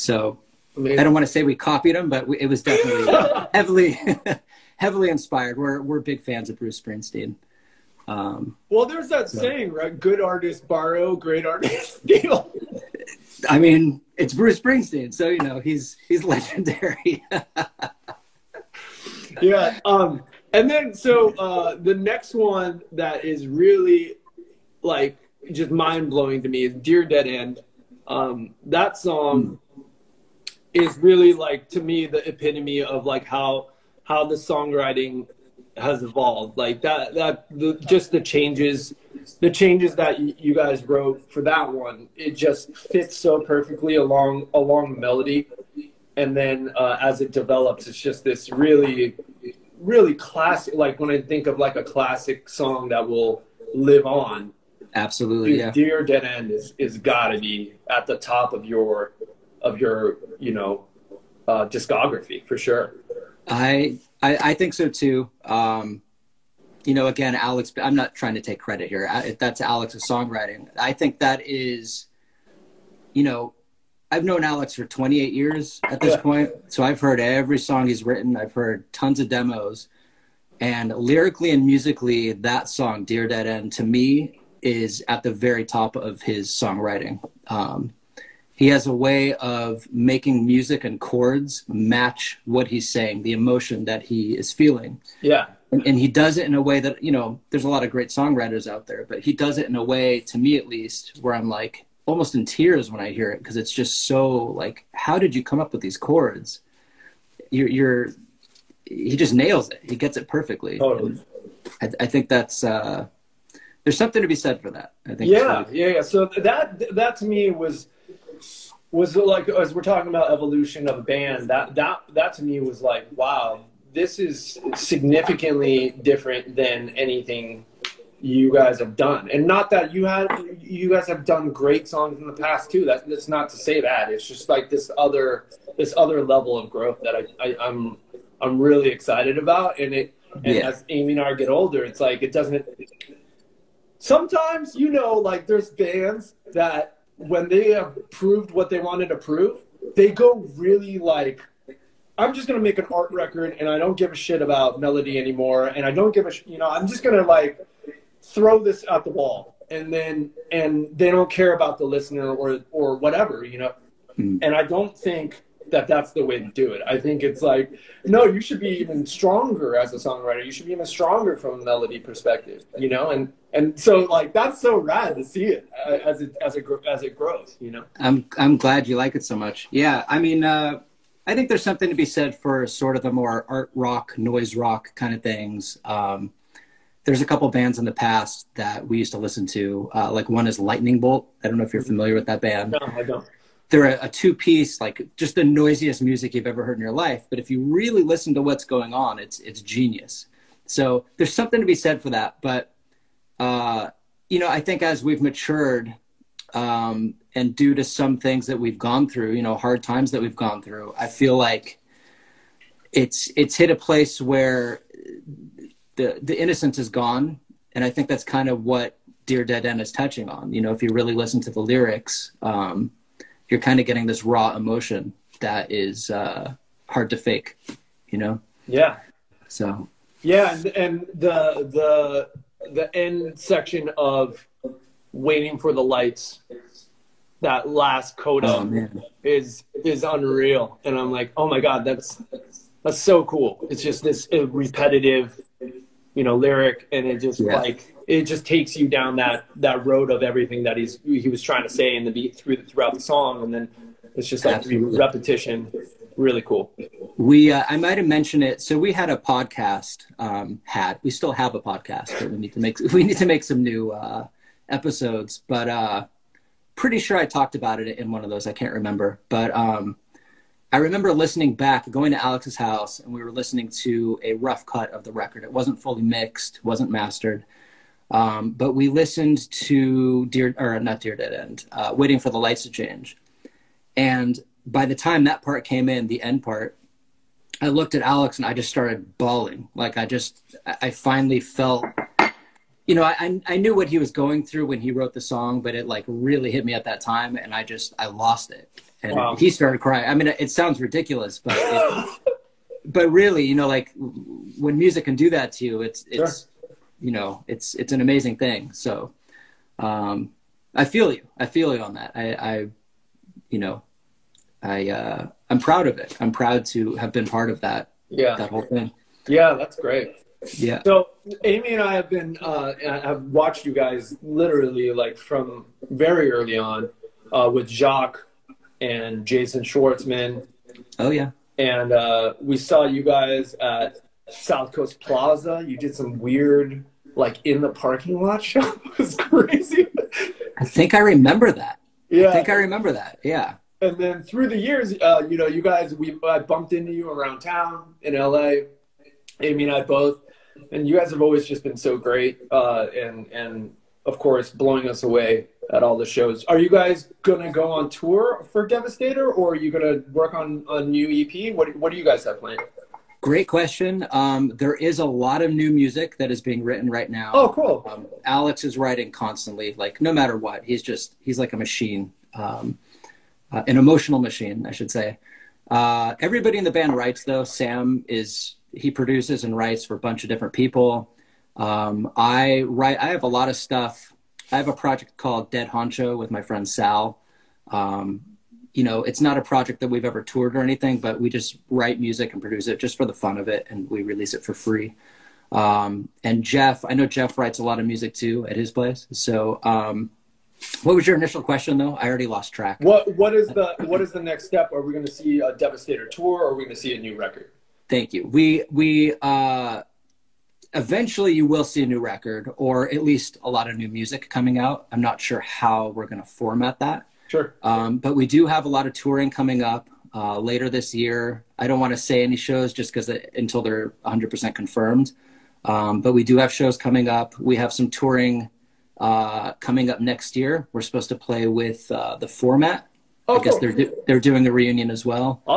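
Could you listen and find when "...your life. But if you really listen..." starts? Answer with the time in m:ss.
3:16.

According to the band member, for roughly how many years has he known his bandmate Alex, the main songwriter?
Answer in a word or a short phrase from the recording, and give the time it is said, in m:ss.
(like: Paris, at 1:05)
28, at 1:14.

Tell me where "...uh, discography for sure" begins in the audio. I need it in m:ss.
1:01.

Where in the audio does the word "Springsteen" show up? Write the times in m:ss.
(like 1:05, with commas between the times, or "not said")
0:06, 0:14.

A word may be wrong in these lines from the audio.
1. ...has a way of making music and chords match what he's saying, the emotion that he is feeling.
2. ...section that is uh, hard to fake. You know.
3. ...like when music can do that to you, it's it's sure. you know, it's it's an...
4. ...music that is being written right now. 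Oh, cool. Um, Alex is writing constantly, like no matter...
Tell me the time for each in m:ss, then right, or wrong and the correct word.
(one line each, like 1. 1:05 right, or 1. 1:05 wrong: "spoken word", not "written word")
1. 1:28 right
2. 3:44 wrong: "emotion", not "section"
3. 5:03 right
4. 6:05 right.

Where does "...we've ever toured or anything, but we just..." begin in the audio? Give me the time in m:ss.
6:29.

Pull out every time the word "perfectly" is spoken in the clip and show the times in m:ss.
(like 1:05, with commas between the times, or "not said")
0:43, 1:50.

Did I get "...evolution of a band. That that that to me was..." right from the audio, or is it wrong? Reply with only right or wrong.
right.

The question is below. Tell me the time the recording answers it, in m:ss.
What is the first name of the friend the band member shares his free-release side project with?
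6:26.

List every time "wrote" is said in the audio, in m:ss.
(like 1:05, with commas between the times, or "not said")
0:40, 4:54.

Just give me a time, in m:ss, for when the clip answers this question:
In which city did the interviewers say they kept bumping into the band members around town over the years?
5:48.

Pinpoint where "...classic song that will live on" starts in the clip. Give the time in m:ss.
0:51.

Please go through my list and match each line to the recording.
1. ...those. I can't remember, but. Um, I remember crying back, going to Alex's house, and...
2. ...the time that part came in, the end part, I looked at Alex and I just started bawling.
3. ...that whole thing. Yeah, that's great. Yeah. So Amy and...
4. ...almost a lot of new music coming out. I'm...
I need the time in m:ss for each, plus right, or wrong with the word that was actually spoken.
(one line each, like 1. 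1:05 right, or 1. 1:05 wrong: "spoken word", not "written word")
1. 4:28 wrong: "listening", not "crying"
2. 4:44 right
3. 5:18 right
4. 6:53 wrong: "least", not "almost".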